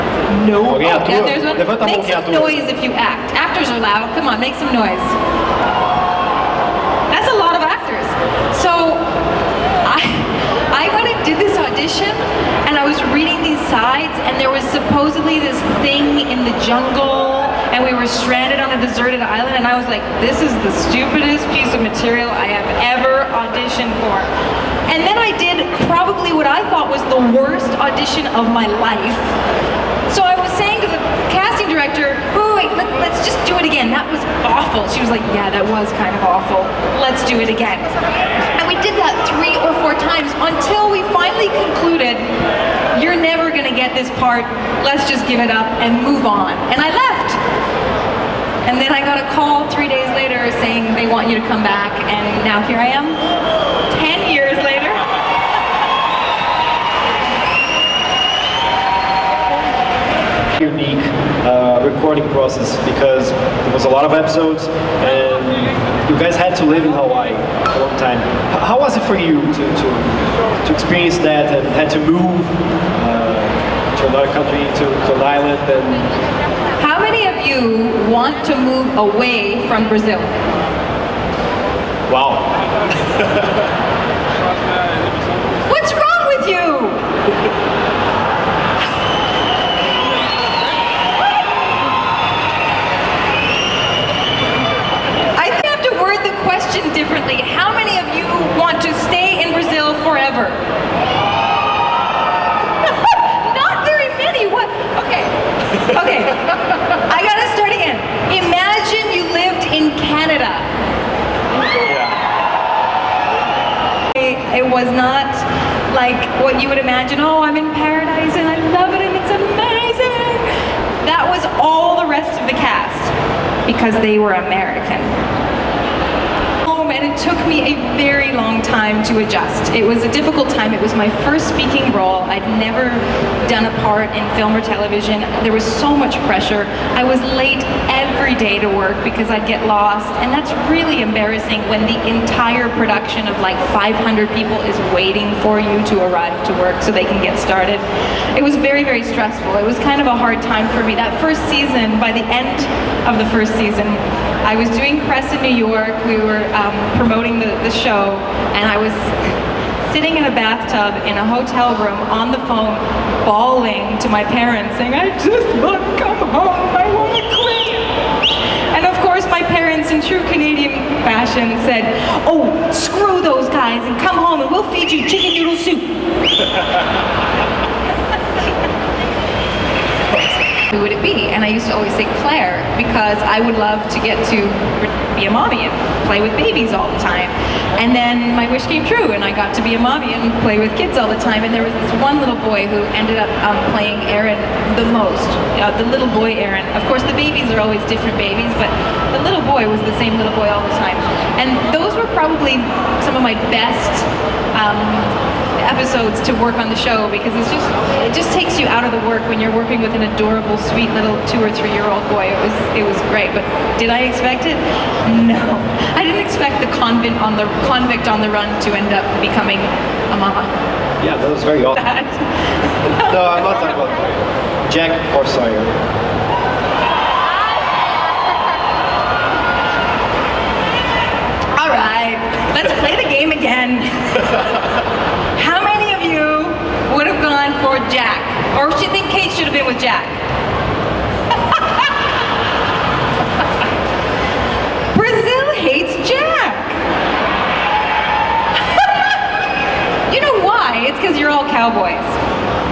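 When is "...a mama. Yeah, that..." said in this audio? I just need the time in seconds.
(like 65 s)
219 s.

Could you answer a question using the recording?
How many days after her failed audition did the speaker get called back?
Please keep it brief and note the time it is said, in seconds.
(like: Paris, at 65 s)
3, at 49 s.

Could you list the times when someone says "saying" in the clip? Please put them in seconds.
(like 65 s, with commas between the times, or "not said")
30 s, 50 s, 164 s.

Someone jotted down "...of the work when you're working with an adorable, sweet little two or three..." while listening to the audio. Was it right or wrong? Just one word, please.
right.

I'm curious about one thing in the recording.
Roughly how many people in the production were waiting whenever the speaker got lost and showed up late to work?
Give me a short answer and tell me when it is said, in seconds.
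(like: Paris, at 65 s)
500, at 143 s.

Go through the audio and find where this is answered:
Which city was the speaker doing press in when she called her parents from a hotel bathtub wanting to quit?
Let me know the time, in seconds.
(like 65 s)
155 s.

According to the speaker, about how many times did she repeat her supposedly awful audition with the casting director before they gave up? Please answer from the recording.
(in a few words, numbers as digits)
3 or 4.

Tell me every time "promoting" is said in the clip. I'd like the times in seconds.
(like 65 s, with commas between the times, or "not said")
156 s.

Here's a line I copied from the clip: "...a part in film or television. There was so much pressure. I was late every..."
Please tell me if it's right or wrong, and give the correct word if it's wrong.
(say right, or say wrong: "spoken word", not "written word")
right.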